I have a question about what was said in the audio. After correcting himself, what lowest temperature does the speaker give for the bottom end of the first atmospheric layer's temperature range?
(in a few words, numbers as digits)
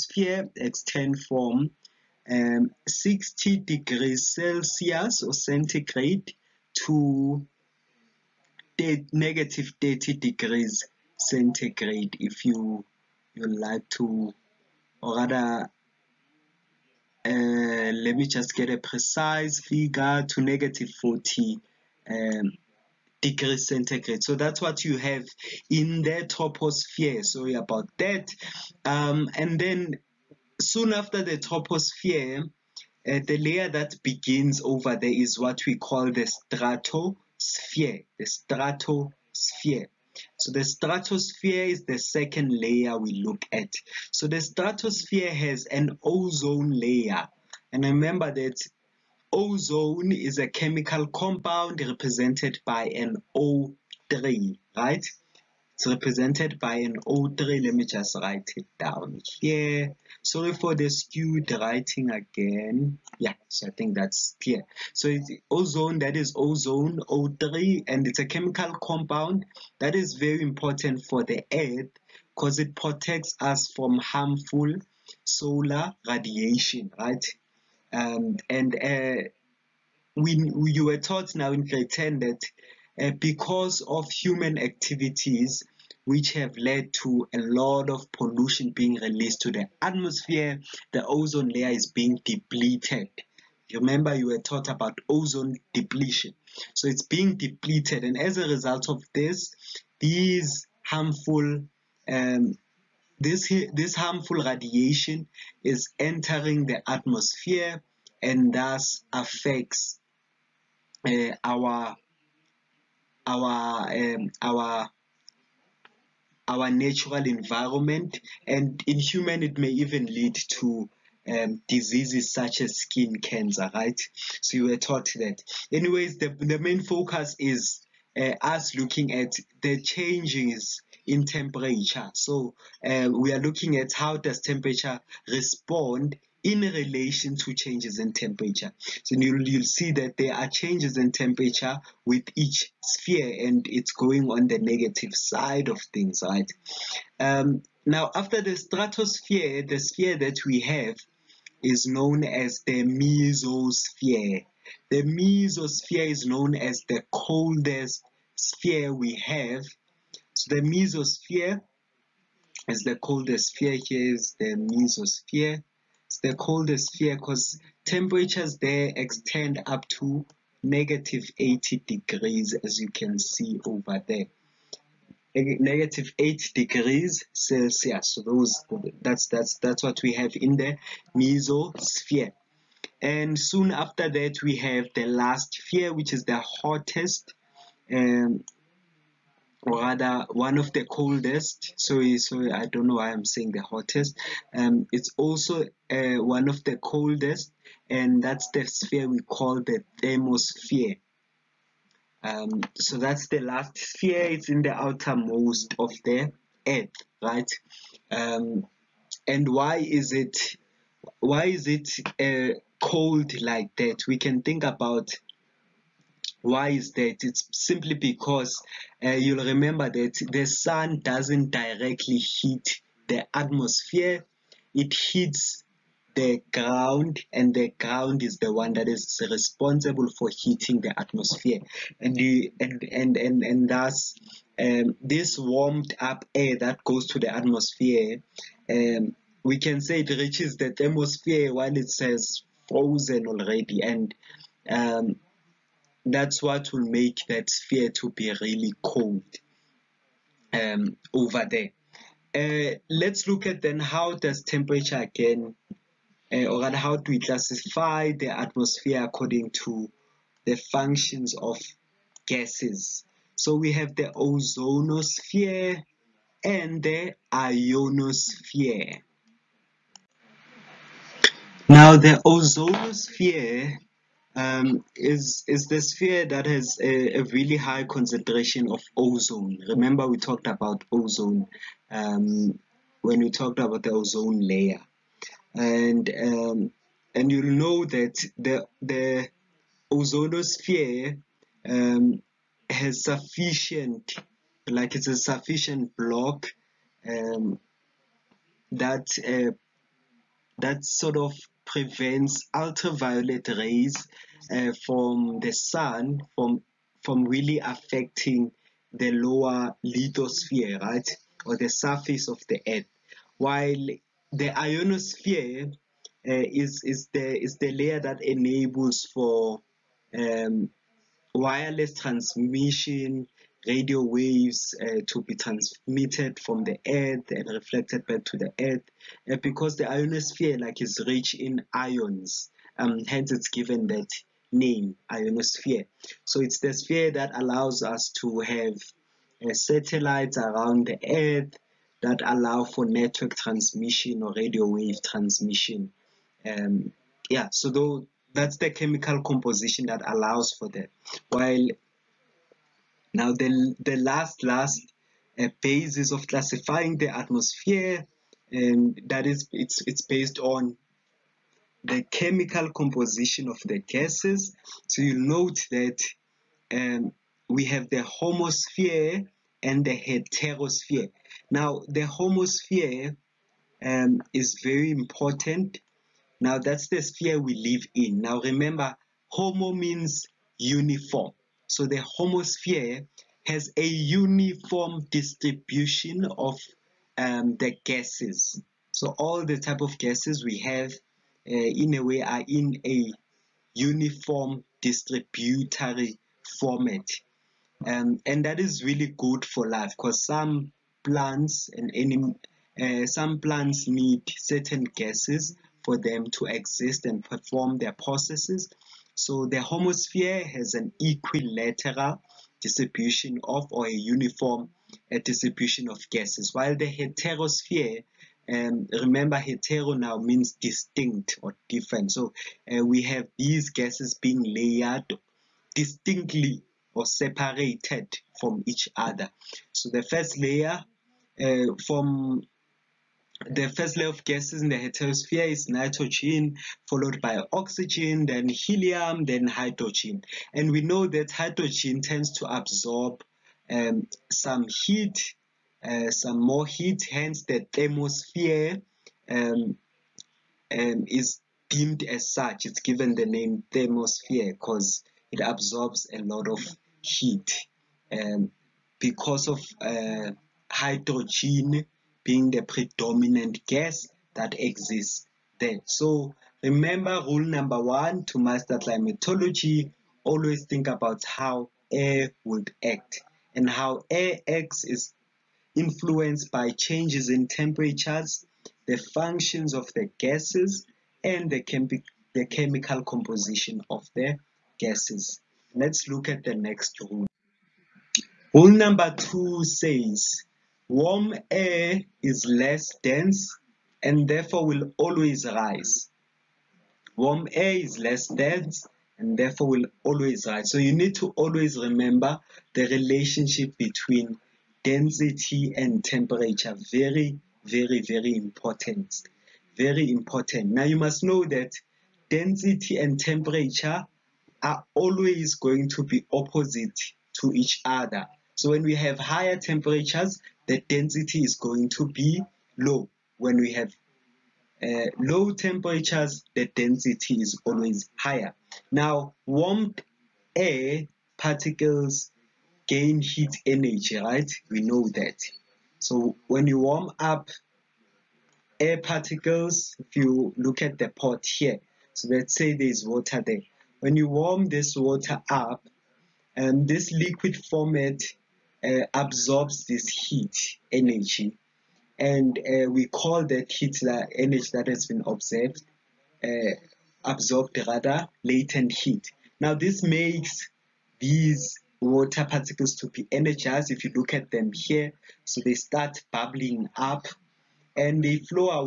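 -40 degrees Celsius.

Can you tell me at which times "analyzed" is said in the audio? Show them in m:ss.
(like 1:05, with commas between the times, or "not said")
not said.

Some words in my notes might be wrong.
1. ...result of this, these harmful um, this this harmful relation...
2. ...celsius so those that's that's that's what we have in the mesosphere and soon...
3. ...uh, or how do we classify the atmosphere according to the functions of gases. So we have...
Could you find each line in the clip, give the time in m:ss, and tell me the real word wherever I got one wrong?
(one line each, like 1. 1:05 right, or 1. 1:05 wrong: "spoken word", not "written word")
1. 1:38 wrong: "radiation", not "relation"
2. 2:57 right
3. 4:16 right.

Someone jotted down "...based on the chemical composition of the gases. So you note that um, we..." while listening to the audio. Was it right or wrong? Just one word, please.
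right.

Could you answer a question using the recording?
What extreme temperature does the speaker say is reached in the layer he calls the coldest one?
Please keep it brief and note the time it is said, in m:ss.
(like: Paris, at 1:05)
-80 degrees Celsius, at 2:50.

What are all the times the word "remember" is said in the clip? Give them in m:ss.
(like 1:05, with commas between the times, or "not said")
0:47, 1:33, 3:39, 4:39, 6:18, 6:58, 7:46, 8:21.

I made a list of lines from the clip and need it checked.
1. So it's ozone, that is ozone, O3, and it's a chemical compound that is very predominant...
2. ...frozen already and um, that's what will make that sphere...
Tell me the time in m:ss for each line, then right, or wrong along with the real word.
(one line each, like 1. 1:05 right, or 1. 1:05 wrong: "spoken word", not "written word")
1. 1:04 wrong: "important", not "predominant"
2. 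4:02 right.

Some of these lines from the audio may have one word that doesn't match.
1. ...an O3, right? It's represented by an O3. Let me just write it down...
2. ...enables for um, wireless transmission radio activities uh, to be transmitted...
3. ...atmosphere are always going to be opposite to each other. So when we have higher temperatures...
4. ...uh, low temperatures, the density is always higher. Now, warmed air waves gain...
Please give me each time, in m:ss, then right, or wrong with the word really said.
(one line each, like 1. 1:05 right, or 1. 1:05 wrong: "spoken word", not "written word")
1. 0:52 right
2. 5:18 wrong: "waves", not "activities"
3. 8:33 wrong: "temperature", not "atmosphere"
4. 8:44 wrong: "particles", not "waves".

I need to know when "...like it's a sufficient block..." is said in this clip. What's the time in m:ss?
4:54.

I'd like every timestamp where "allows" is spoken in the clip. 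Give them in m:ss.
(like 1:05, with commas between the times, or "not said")
5:37, 5:42, 5:50.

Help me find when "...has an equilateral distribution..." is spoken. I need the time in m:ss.
6:50.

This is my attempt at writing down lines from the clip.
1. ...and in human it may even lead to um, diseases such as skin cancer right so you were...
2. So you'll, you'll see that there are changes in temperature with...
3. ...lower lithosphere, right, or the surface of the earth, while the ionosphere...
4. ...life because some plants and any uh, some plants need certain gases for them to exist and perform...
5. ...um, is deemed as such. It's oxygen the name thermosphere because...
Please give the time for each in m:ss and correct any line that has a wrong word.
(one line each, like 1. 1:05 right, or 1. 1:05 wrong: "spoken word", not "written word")
1. 1:58 right
2. 2:18 right
3. 5:09 right
4. 6:39 right
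5. 7:30 wrong: "given", not "oxygen".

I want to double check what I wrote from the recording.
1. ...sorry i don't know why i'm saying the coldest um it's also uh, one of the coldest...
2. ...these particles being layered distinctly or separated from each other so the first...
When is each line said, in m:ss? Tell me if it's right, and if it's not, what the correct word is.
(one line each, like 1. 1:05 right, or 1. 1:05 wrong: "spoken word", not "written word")
1. 3:12 wrong: "hottest", not "coldest"
2. 7:03 wrong: "gases", not "particles".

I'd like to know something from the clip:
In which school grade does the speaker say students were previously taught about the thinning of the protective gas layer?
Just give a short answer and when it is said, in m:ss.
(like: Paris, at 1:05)
Grade 10, at 1:21.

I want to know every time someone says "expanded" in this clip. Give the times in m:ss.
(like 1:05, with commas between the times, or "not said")
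not said.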